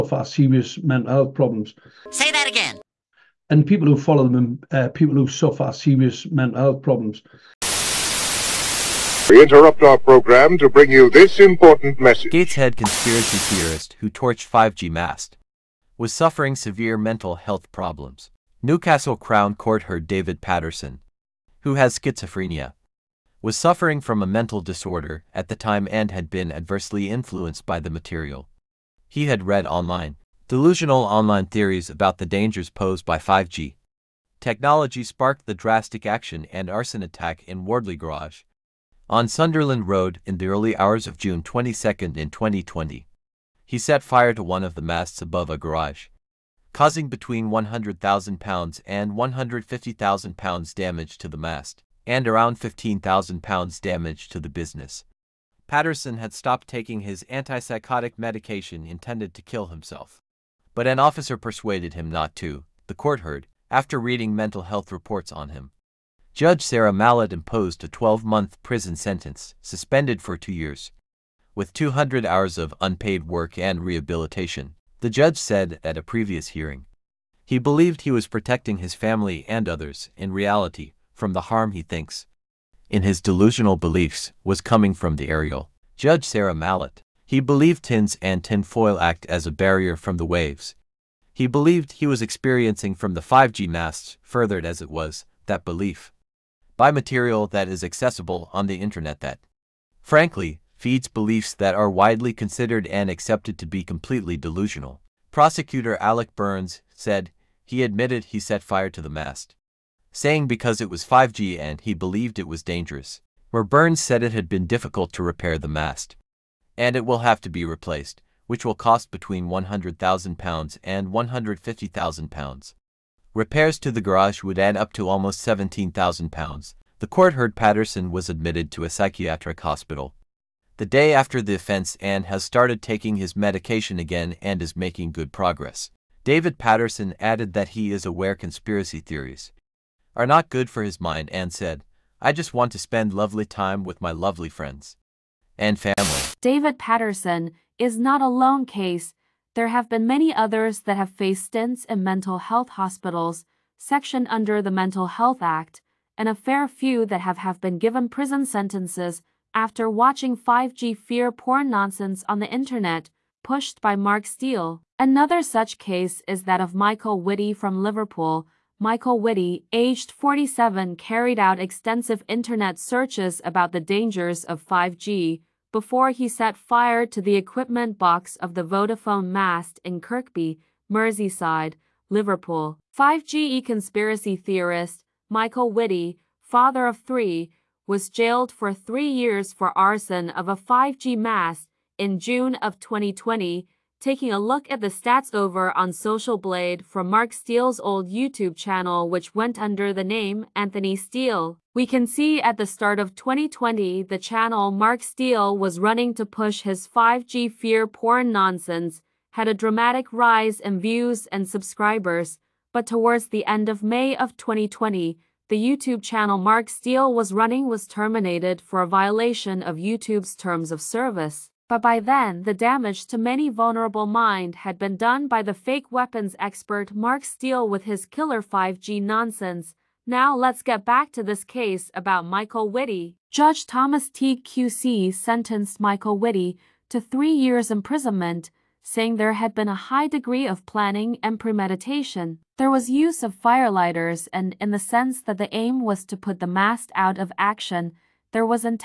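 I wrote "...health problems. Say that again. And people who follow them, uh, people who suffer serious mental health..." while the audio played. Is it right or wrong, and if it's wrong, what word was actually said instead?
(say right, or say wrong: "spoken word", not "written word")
right.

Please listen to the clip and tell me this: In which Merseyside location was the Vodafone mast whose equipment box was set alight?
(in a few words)
Kirkby.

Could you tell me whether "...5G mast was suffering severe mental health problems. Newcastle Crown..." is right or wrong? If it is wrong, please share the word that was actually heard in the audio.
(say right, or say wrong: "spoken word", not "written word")
right.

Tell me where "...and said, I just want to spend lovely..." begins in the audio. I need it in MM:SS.
02:21.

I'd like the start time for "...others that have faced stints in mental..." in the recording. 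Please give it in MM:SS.
02:30.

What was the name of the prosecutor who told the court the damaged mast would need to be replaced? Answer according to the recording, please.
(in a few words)
Alec Burns.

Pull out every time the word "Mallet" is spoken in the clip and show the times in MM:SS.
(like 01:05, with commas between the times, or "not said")
01:06, 01:26.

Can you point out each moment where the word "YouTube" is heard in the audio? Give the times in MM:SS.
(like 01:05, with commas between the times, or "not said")
03:18, 03:35, 03:39.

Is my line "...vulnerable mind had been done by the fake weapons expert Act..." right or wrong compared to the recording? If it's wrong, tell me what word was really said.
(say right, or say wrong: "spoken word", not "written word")
wrong: "Mark", not "Act".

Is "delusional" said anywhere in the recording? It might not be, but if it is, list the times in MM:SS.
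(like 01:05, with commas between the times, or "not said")
00:30, 01:23, 01:44.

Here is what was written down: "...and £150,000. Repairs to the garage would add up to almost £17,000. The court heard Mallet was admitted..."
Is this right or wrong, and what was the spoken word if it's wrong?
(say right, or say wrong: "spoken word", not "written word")
wrong: "Patterson", not "Mallet".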